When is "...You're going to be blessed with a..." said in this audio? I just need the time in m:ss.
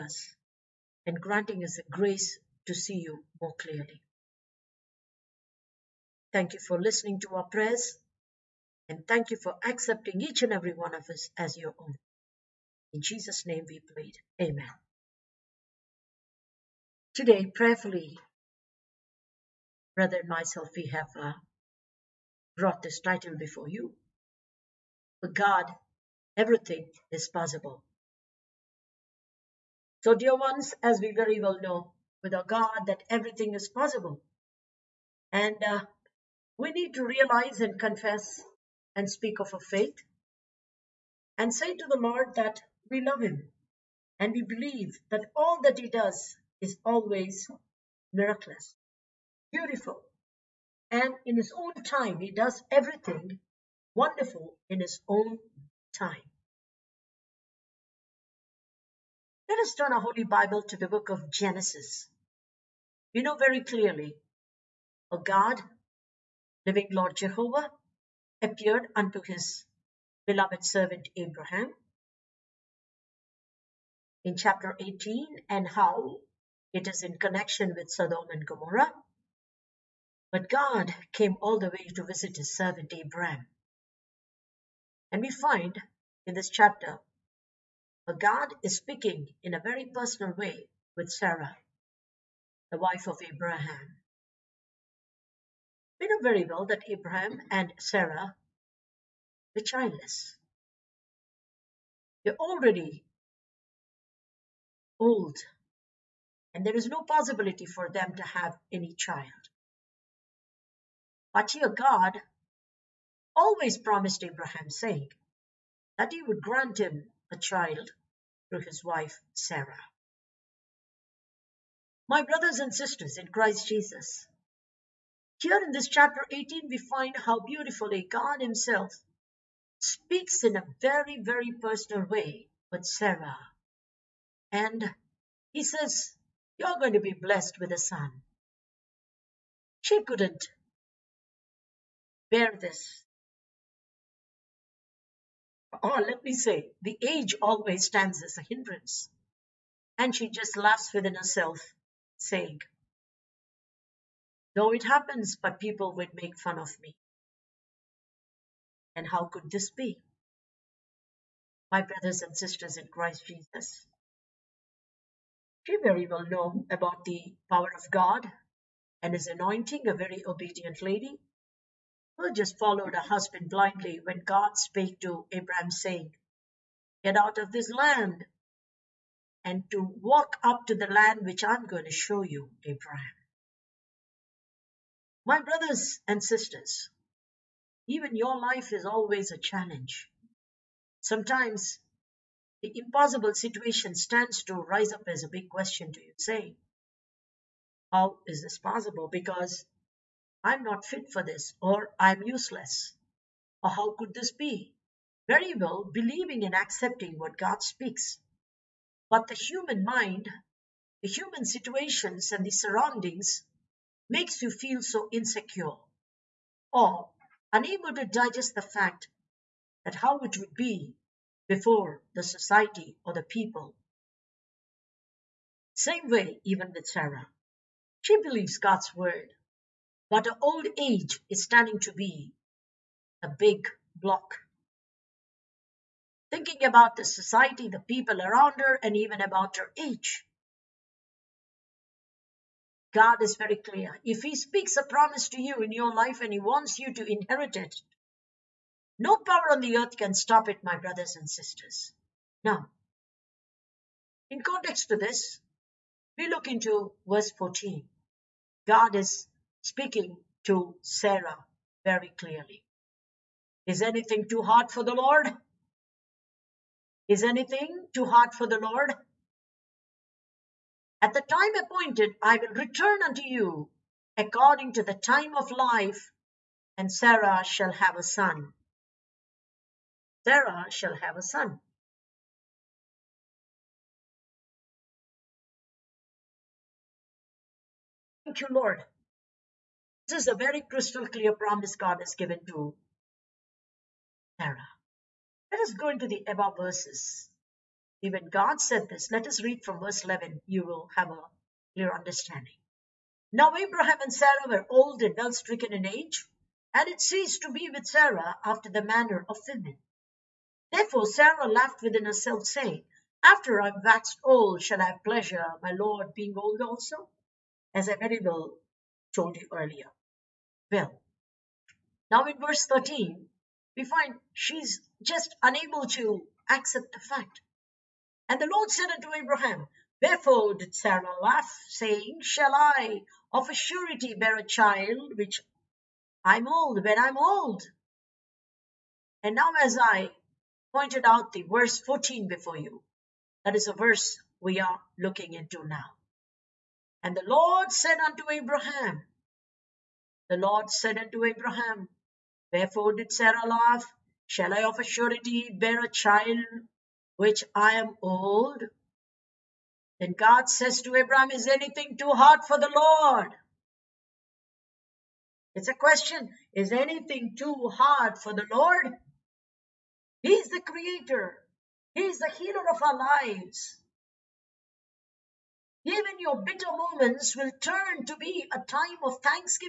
2:16.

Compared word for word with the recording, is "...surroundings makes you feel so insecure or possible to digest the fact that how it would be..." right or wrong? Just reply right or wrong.
wrong.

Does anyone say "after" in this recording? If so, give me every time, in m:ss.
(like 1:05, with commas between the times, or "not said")
5:08, 5:13.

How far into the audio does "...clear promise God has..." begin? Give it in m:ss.
4:51.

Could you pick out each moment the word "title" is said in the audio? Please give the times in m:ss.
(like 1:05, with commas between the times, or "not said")
0:22.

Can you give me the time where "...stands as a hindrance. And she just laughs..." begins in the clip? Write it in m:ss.
2:27.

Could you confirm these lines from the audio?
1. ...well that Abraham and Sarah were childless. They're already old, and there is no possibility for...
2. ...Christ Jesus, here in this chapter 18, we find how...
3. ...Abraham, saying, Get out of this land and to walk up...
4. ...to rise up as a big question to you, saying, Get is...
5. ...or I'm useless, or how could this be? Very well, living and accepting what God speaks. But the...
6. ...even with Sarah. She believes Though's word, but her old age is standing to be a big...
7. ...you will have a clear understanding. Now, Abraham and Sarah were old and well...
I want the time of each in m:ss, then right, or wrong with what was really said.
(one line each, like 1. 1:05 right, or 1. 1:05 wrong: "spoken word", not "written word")
1. 1:36 right
2. 2:03 right
3. 2:55 right
4. 3:14 wrong: "How", not "Get"
5. 3:21 wrong: "believing", not "living"
6. 3:46 wrong: "God", not "Though"
7. 5:00 right.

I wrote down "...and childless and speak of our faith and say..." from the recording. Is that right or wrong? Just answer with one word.
wrong.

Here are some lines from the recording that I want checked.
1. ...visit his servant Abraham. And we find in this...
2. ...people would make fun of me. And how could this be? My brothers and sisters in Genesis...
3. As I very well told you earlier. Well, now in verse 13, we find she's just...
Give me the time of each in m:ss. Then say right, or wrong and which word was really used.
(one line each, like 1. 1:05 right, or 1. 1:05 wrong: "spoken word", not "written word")
1. 1:22 right
2. 2:35 wrong: "Christ", not "Genesis"
3. 5:17 right.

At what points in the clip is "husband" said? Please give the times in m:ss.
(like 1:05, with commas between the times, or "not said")
2:52.